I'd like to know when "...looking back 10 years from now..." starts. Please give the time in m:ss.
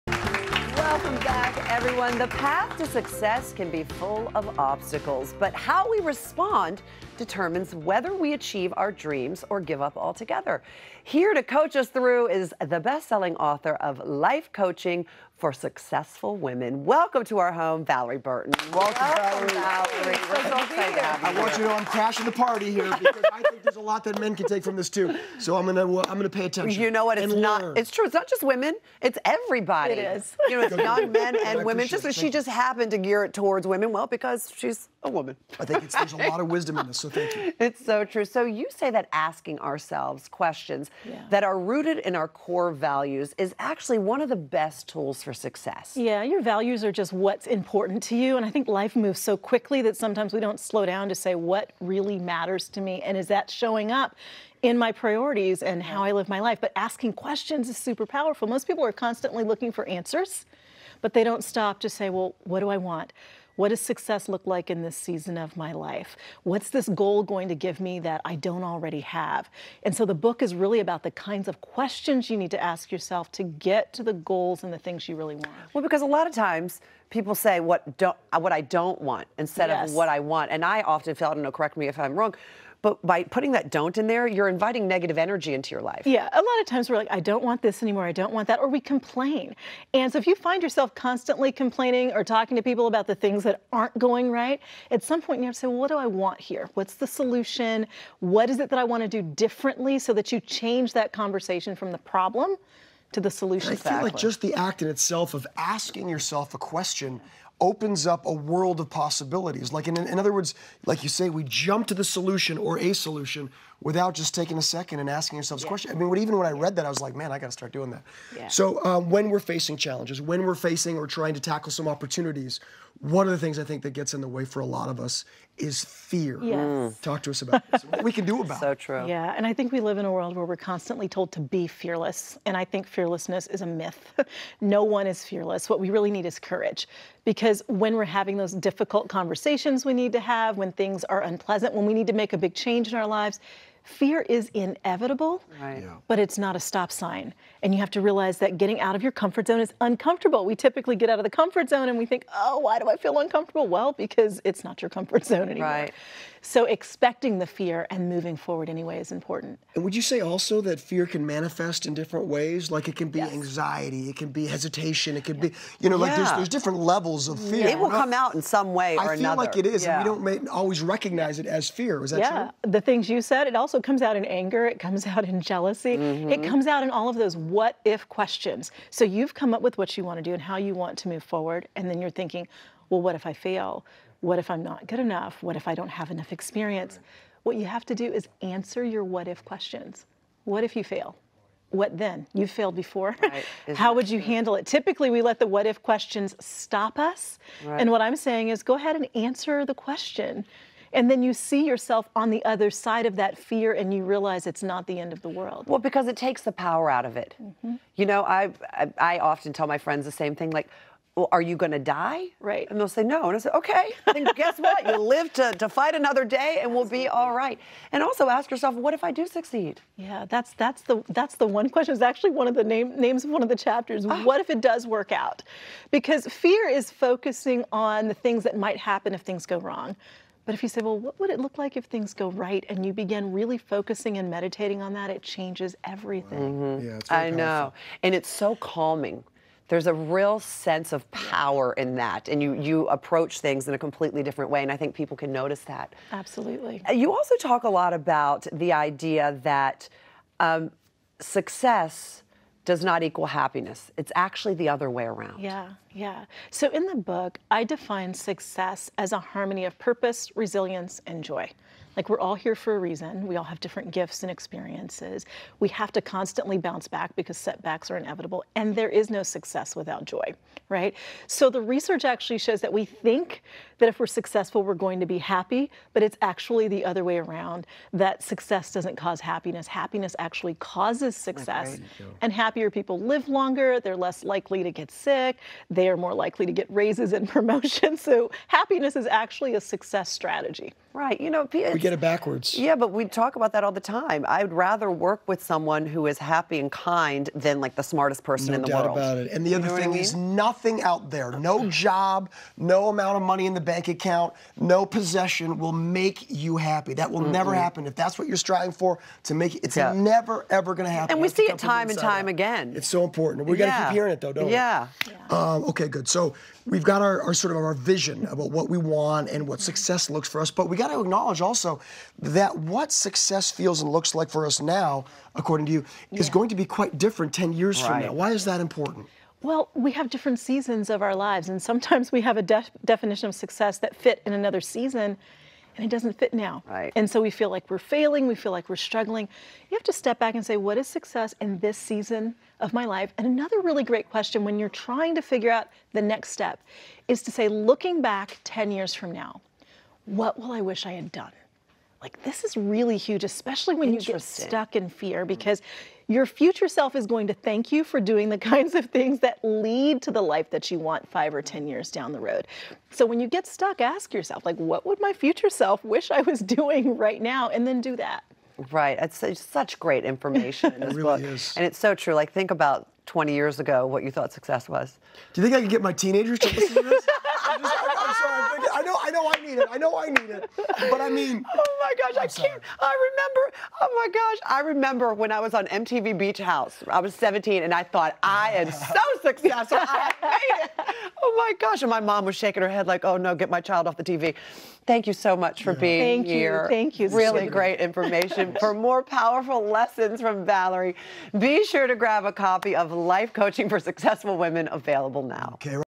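5:47.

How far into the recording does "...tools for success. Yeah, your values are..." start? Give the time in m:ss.
0:44.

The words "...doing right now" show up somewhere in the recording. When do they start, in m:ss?
6:06.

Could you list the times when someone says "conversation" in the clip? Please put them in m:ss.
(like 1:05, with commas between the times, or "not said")
1:41, 2:19.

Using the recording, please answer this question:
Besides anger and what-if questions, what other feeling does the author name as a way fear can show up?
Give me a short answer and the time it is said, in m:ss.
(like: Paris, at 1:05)
Jealousy, at 2:55.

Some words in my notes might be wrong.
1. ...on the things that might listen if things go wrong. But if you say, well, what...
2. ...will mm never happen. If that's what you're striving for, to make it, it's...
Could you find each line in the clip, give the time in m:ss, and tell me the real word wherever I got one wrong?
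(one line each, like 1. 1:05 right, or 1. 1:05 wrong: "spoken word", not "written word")
1. 3:47 wrong: "happen", not "listen"
2. 5:07 right.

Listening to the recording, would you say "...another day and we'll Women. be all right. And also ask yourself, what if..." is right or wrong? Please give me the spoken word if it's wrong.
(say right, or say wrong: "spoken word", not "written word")
wrong: "Absolutely", not "Women".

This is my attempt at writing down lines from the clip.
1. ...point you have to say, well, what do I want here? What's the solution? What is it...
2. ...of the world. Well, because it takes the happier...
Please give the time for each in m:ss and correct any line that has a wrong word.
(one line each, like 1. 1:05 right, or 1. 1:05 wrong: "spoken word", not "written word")
1. 1:35 right
2. 3:25 wrong: "power", not "happier".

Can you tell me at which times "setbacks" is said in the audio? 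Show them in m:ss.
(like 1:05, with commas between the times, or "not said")
4:27.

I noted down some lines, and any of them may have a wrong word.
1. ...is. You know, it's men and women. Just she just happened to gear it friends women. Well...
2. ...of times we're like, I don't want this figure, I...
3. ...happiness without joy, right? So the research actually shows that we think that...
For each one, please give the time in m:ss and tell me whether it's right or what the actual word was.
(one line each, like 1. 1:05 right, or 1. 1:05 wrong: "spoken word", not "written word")
1. 0:30 wrong: "towards", not "friends"
2. 1:26 wrong: "anymore", not "figure"
3. 4:29 wrong: "success", not "happiness".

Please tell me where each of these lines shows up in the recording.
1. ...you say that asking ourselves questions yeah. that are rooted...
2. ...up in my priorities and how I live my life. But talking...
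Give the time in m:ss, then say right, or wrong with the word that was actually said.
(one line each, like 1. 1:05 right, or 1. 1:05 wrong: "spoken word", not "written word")
1. 0:38 right
2. 0:53 wrong: "asking", not "talking".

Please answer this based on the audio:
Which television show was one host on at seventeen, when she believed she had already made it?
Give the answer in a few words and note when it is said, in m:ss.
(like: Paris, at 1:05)
MTV Beach House, at 6:25.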